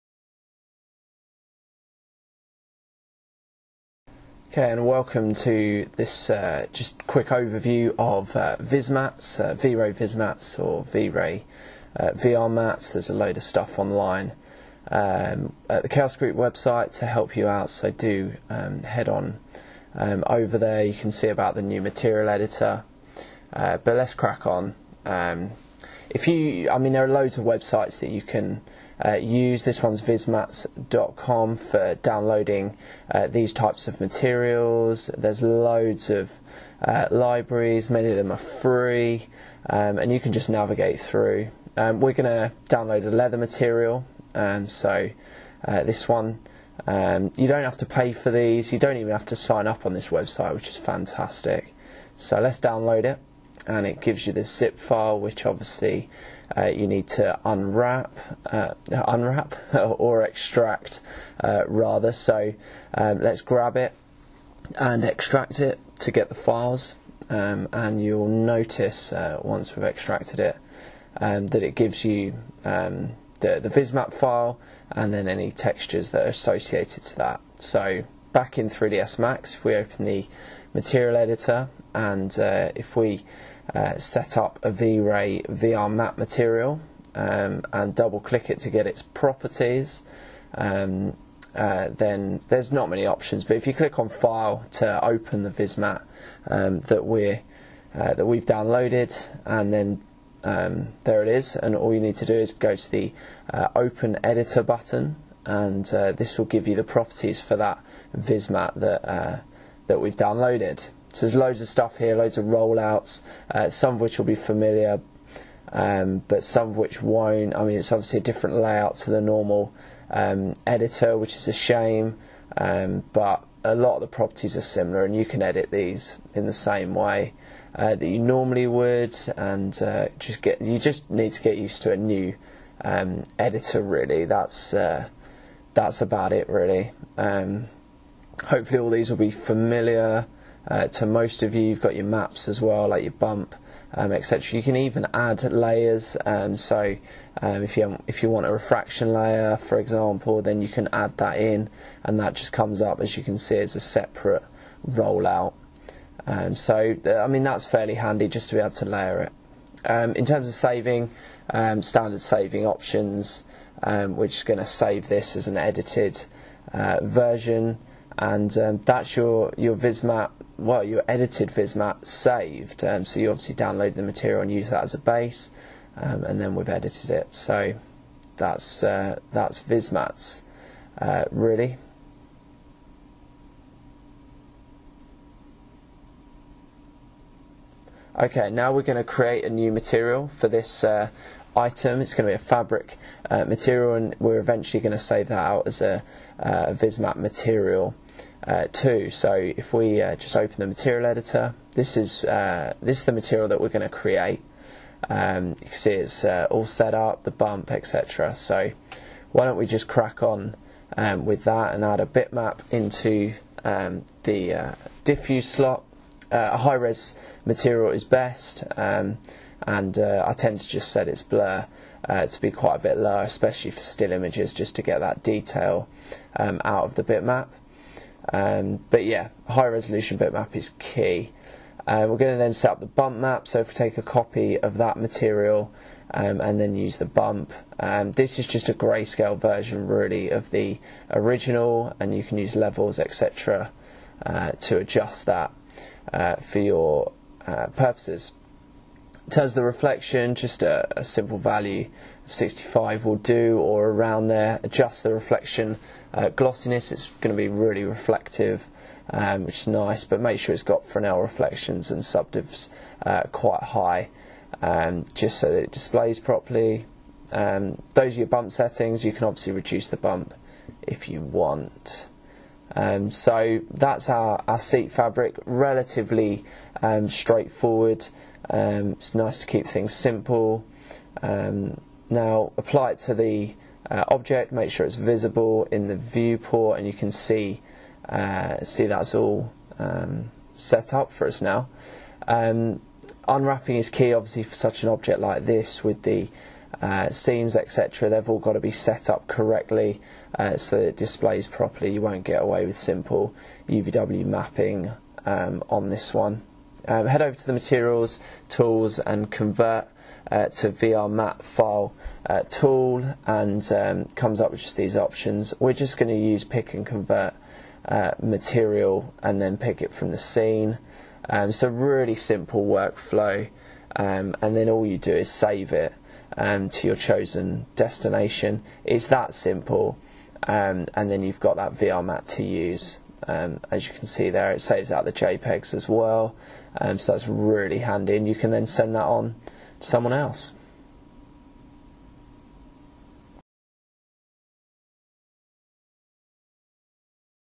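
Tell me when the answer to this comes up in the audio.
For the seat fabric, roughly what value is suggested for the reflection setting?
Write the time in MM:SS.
04:12.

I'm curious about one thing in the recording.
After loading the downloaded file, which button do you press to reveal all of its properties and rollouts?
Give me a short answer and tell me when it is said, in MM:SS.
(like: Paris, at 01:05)
Open Editor, at 01:43.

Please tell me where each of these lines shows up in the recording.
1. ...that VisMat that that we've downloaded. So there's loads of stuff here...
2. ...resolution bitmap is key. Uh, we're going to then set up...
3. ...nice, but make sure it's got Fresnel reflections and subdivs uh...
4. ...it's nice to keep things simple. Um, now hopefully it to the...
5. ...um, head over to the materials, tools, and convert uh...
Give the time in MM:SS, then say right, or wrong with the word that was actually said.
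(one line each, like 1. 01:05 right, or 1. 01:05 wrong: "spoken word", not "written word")
1. 01:47 right
2. 03:49 right
3. 04:19 right
4. 04:38 wrong: "apply", not "hopefully"
5. 05:06 right.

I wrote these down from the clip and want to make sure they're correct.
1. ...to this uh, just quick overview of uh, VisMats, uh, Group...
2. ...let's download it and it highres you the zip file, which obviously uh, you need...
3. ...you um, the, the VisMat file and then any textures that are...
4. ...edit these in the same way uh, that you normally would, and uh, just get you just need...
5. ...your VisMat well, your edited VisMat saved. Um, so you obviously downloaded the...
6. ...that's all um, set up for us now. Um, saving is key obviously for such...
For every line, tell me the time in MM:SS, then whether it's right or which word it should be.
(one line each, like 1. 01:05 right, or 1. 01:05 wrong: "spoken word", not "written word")
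1. 00:05 wrong: "VRay", not "Group"
2. 00:52 wrong: "gives", not "highres"
3. 01:12 right
4. 02:05 right
5. 02:49 right
6. 04:48 wrong: "unwrapping", not "saving".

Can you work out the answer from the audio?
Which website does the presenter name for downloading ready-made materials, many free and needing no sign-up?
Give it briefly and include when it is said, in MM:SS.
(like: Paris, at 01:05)
vismats.com, at 00:30.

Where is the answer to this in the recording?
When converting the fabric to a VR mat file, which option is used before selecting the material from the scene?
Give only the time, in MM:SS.
05:16.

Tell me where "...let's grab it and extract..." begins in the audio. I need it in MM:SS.
01:03.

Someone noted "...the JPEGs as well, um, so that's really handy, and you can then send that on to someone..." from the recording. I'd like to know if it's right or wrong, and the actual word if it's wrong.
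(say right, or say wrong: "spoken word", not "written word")
right.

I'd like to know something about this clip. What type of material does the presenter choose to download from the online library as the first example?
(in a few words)
Leather.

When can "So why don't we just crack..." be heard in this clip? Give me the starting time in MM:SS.
03:28.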